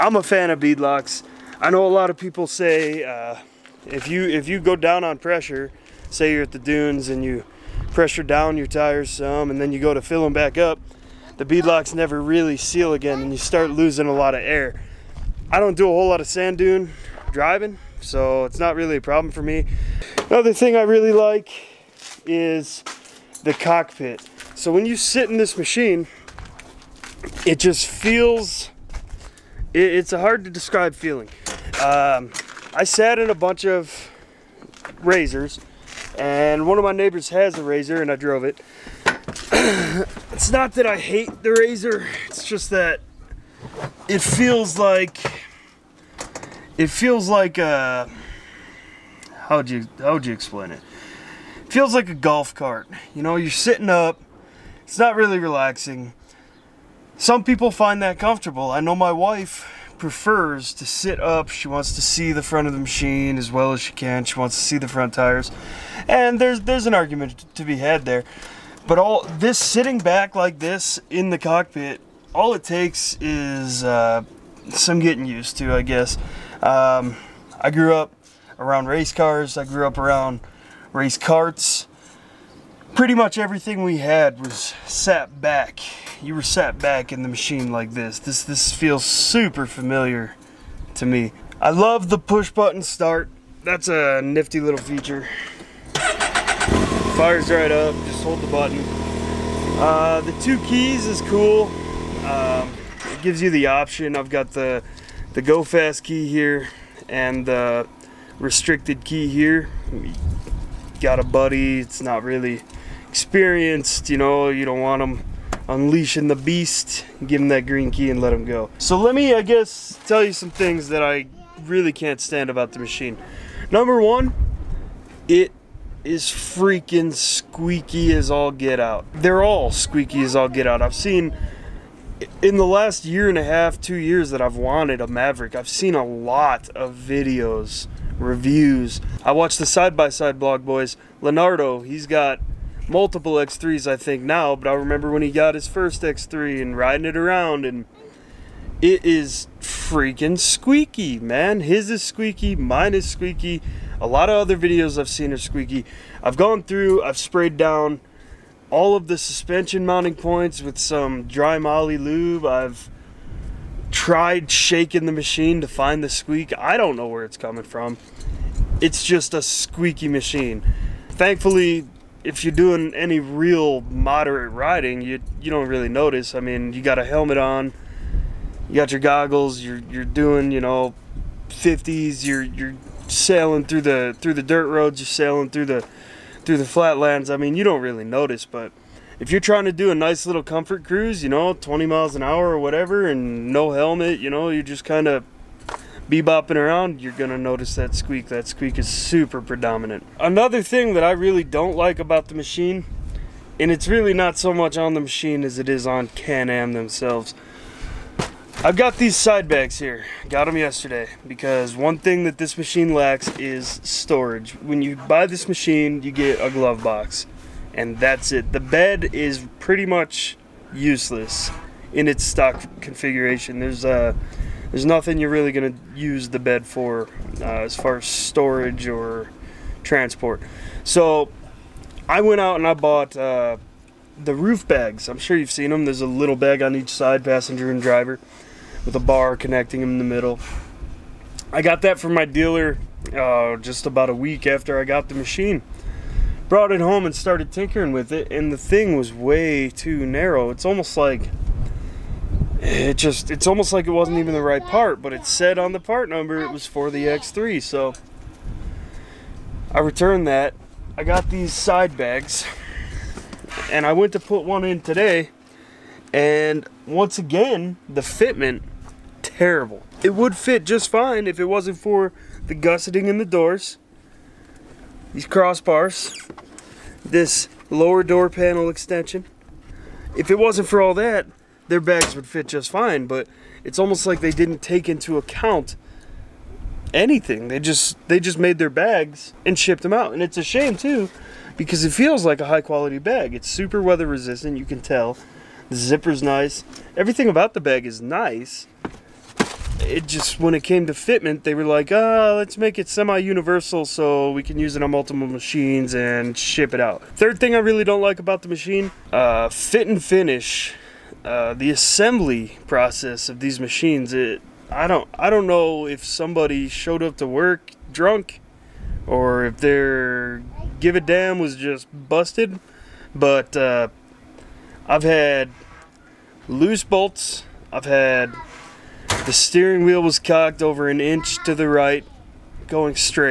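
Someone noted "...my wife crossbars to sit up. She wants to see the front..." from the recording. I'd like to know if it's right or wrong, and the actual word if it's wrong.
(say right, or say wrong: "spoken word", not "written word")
wrong: "prefers", not "crossbars".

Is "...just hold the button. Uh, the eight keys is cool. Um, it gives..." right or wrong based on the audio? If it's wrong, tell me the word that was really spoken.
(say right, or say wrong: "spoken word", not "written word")
wrong: "two", not "eight".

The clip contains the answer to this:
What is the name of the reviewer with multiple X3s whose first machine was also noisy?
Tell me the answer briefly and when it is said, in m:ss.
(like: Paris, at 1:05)
Leonardo, at 2:21.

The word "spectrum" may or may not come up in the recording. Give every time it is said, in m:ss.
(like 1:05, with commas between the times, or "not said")
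not said.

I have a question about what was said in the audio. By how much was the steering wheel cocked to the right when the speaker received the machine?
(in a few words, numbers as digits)
an inch.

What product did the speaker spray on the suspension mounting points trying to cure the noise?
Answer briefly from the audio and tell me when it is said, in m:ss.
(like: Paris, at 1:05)
dry moly lube, at 2:41.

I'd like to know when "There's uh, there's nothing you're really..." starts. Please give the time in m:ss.
3:43.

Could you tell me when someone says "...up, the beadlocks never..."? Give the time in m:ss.
0:10.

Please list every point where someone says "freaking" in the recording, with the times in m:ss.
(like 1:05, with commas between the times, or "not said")
2:06, 2:29.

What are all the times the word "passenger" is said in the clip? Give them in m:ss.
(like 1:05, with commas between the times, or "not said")
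3:57.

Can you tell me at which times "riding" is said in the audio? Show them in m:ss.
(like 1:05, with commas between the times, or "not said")
2:26, 2:54.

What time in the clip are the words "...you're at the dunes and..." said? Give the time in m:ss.
0:06.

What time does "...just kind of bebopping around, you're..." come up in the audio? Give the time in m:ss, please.
3:14.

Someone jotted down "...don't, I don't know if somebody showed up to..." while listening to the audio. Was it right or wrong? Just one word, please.
right.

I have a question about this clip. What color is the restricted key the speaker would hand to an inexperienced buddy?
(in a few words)
green.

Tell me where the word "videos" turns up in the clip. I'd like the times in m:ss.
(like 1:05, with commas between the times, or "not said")
2:16, 2:34.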